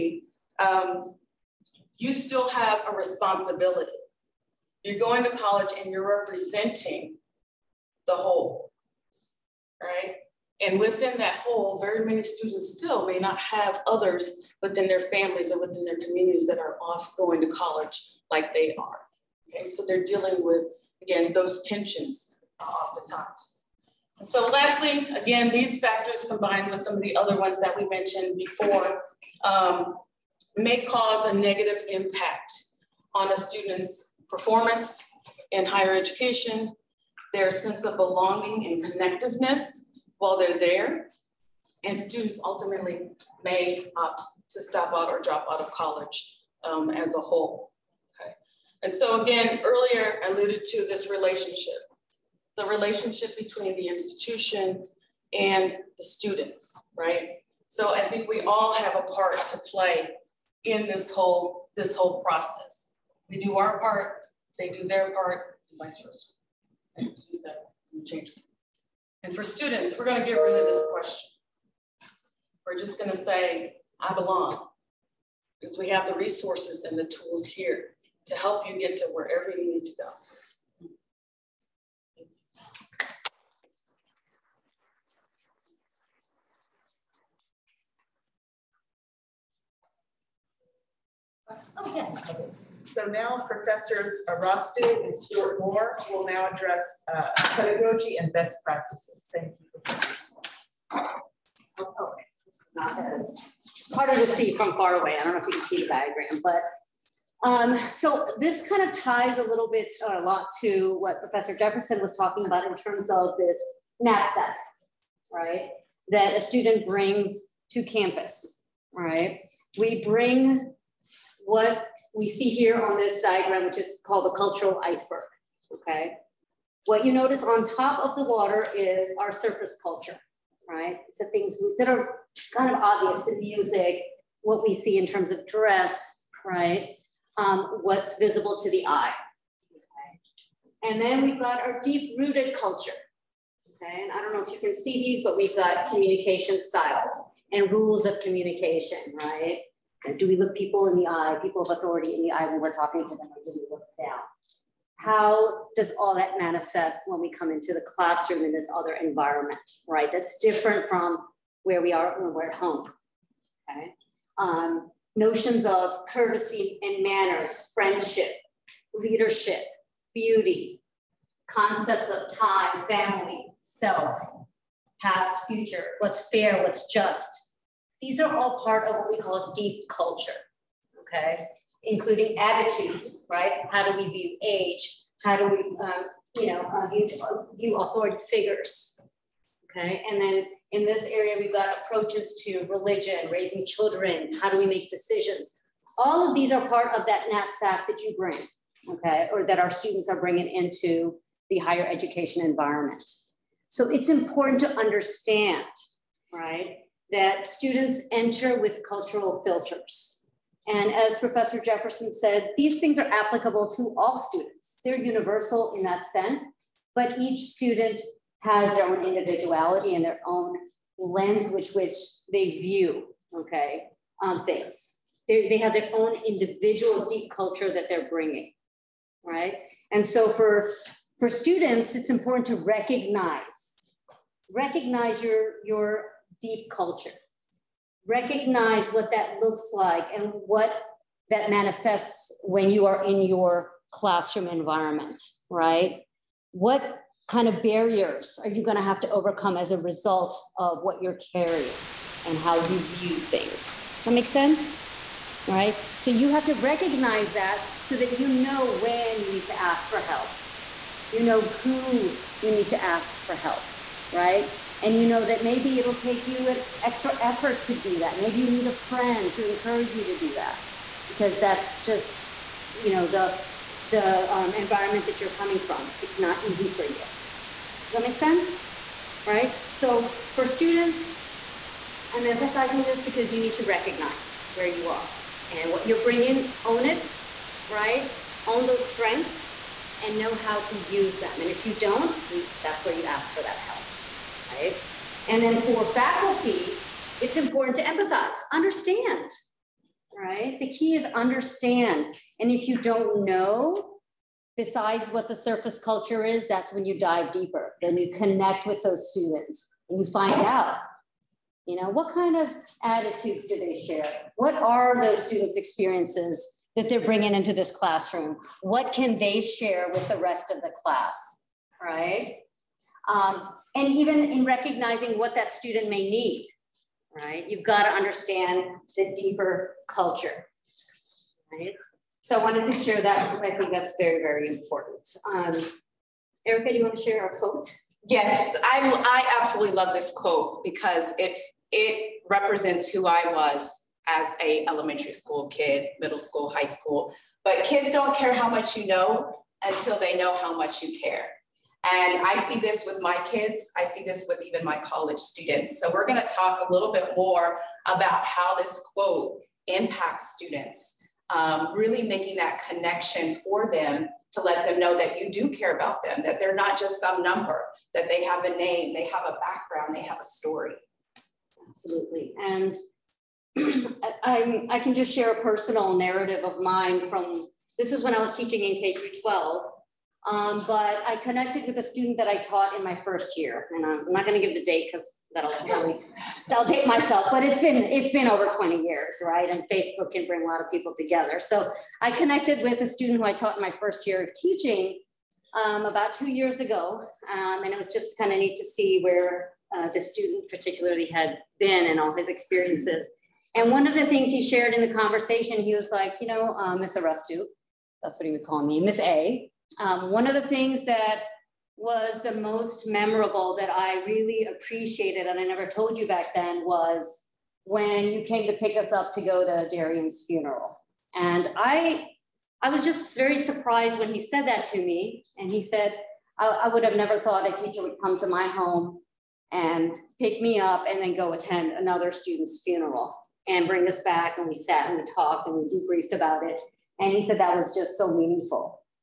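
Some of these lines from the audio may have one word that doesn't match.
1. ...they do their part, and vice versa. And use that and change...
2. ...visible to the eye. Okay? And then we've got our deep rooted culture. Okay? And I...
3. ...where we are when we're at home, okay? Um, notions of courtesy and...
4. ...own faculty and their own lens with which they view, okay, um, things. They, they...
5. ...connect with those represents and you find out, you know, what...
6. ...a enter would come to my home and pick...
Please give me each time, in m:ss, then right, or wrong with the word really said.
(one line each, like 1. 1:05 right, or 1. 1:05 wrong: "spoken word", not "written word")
1. 1:04 right
2. 2:18 right
3. 2:41 right
4. 3:38 wrong: "individuality", not "faculty"
5. 5:08 wrong: "students", not "represents"
6. 7:07 wrong: "teacher", not "enter".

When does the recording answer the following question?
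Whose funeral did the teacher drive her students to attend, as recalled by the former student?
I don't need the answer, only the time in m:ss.
6:59.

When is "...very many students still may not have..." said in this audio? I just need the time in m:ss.
0:11.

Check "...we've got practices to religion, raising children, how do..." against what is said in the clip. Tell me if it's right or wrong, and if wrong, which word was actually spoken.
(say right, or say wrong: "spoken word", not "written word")
wrong: "approaches", not "practices".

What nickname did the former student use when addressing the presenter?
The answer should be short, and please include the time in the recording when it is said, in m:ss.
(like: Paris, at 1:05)
Miss A, at 6:48.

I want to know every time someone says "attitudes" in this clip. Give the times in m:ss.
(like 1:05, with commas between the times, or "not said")
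3:02, 5:12.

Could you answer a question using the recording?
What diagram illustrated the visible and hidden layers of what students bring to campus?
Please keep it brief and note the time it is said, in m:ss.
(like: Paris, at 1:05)
cultural iceberg, at 2:04.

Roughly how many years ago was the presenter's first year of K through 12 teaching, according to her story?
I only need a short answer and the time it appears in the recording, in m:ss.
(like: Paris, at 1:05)
over 20 years, at 6:28.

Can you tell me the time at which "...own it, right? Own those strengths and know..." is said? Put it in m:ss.
4:46.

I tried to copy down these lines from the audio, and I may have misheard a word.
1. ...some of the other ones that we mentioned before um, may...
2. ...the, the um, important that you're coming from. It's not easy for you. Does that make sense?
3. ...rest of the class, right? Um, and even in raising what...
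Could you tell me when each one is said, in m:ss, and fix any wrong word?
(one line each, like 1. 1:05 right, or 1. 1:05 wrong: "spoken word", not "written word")
1. 0:26 right
2. 4:33 wrong: "environment", not "important"
3. 5:20 wrong: "recognizing", not "raising".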